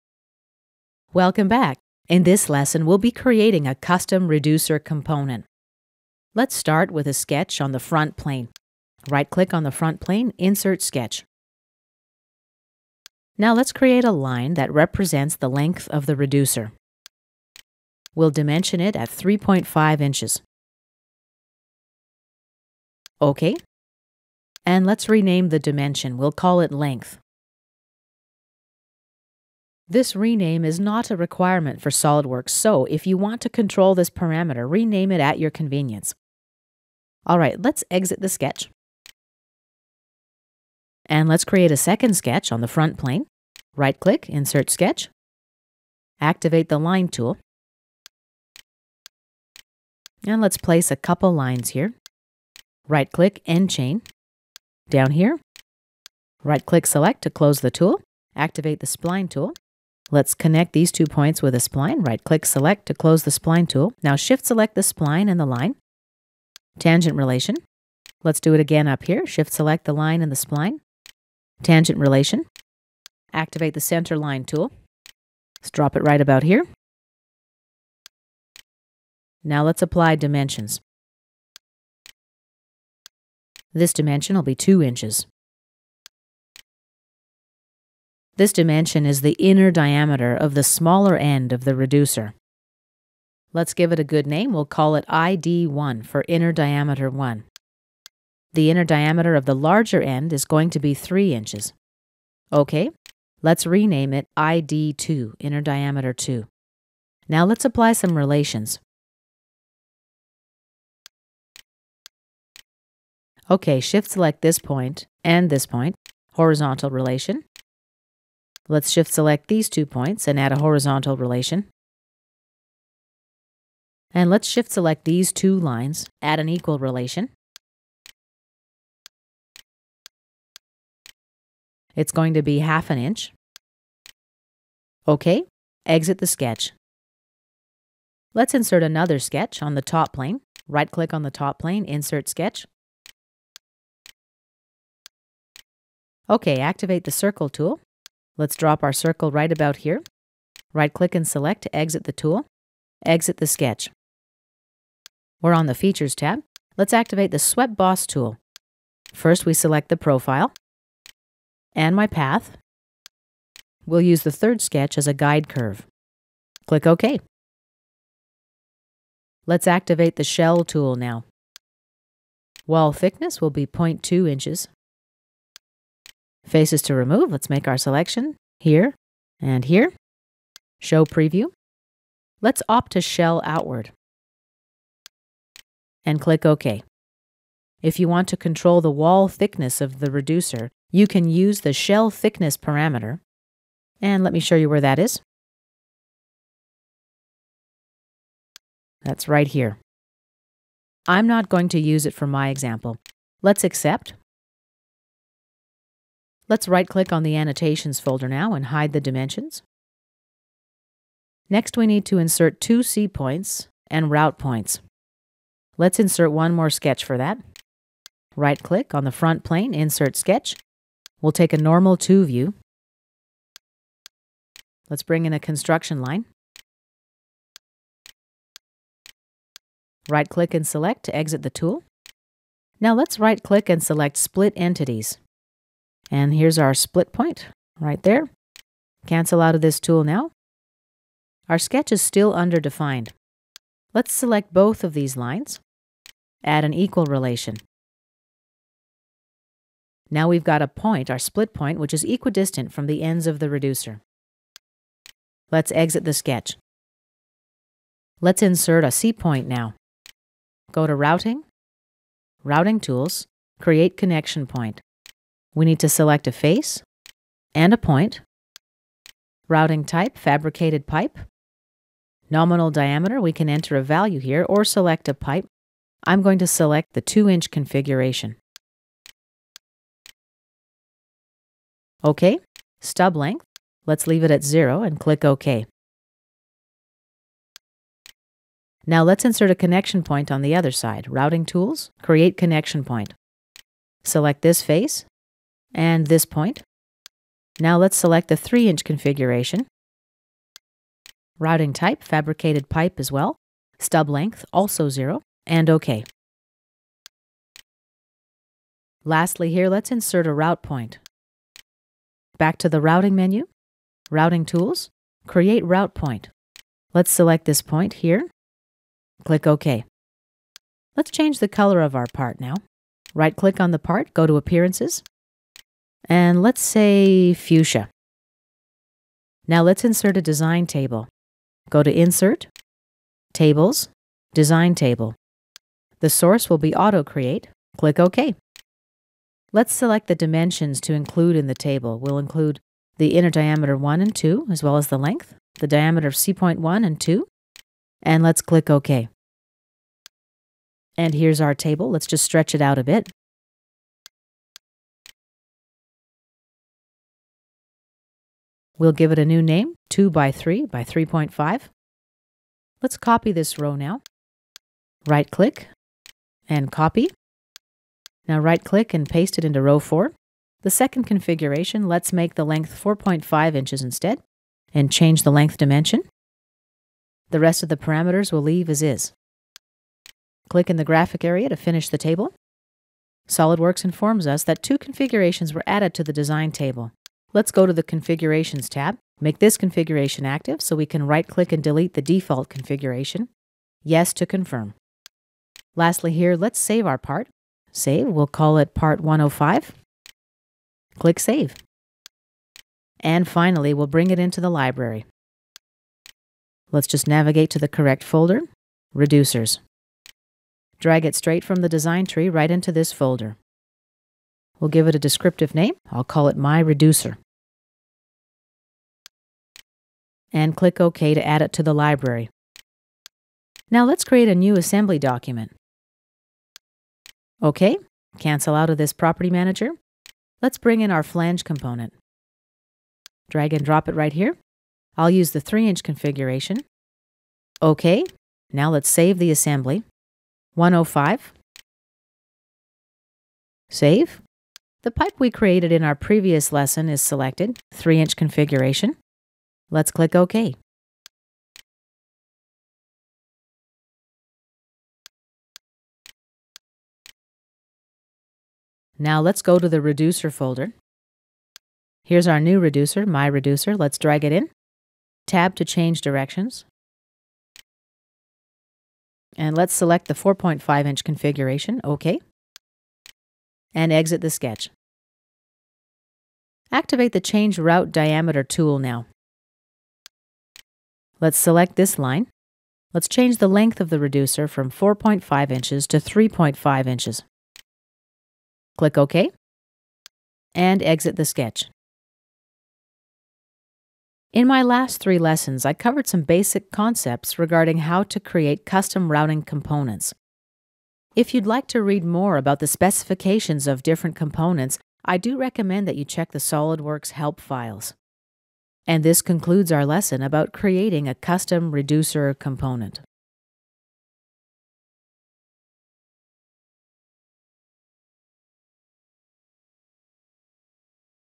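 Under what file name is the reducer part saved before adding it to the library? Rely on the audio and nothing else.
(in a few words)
part 105.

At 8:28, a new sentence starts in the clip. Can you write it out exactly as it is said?
And this concludes our lesson about creating a custom reducer component.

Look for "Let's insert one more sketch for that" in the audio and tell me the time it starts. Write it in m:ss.
3:35.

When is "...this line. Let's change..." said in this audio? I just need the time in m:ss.
8:01.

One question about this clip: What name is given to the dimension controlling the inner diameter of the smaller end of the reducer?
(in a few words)
ID1.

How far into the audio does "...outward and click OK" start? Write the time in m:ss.
3:03.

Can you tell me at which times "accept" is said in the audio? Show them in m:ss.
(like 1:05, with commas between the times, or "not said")
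3:23.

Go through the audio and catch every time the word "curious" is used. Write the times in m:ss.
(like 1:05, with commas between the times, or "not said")
not said.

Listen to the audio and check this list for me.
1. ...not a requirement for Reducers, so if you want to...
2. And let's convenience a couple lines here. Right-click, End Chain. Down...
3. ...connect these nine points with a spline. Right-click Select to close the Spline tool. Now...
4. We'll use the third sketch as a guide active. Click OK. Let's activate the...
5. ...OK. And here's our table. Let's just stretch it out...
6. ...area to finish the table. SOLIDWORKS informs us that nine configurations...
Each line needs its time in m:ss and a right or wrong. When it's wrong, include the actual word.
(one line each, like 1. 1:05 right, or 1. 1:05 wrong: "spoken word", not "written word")
1. 0:30 wrong: "SOLIDWORKS", not "Reducers"
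2. 0:50 wrong: "place", not "convenience"
3. 1:00 wrong: "two", not "nine"
4. 2:43 wrong: "curve", not "active"
5. 5:48 right
6. 6:21 wrong: "two", not "nine".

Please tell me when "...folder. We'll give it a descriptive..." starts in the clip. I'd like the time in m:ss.
6:52.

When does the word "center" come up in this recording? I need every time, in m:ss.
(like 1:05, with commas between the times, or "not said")
1:13.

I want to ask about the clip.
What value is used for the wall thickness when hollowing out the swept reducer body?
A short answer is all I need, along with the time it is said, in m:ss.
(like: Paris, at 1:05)
0.2 inches, at 2:53.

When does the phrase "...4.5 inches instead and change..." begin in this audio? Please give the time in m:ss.
6:12.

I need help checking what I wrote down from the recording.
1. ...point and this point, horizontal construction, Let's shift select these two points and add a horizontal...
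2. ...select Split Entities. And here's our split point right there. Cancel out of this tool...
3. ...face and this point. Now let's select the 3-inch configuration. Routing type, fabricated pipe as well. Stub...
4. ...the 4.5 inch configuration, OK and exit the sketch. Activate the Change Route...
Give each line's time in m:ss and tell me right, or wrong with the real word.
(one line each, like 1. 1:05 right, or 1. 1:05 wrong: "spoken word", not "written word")
1. 1:54 wrong: "relation", not "construction"
2. 3:53 right
3. 4:54 right
4. 7:50 right.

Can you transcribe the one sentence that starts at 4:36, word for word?
I'm going to select the 2-inch configuration.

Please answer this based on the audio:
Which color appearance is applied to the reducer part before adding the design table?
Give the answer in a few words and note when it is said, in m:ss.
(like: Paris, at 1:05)
fuchsia, at 5:27.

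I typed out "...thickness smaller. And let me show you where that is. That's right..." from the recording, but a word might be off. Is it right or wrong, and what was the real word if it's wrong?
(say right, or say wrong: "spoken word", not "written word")
wrong: "parameter", not "smaller".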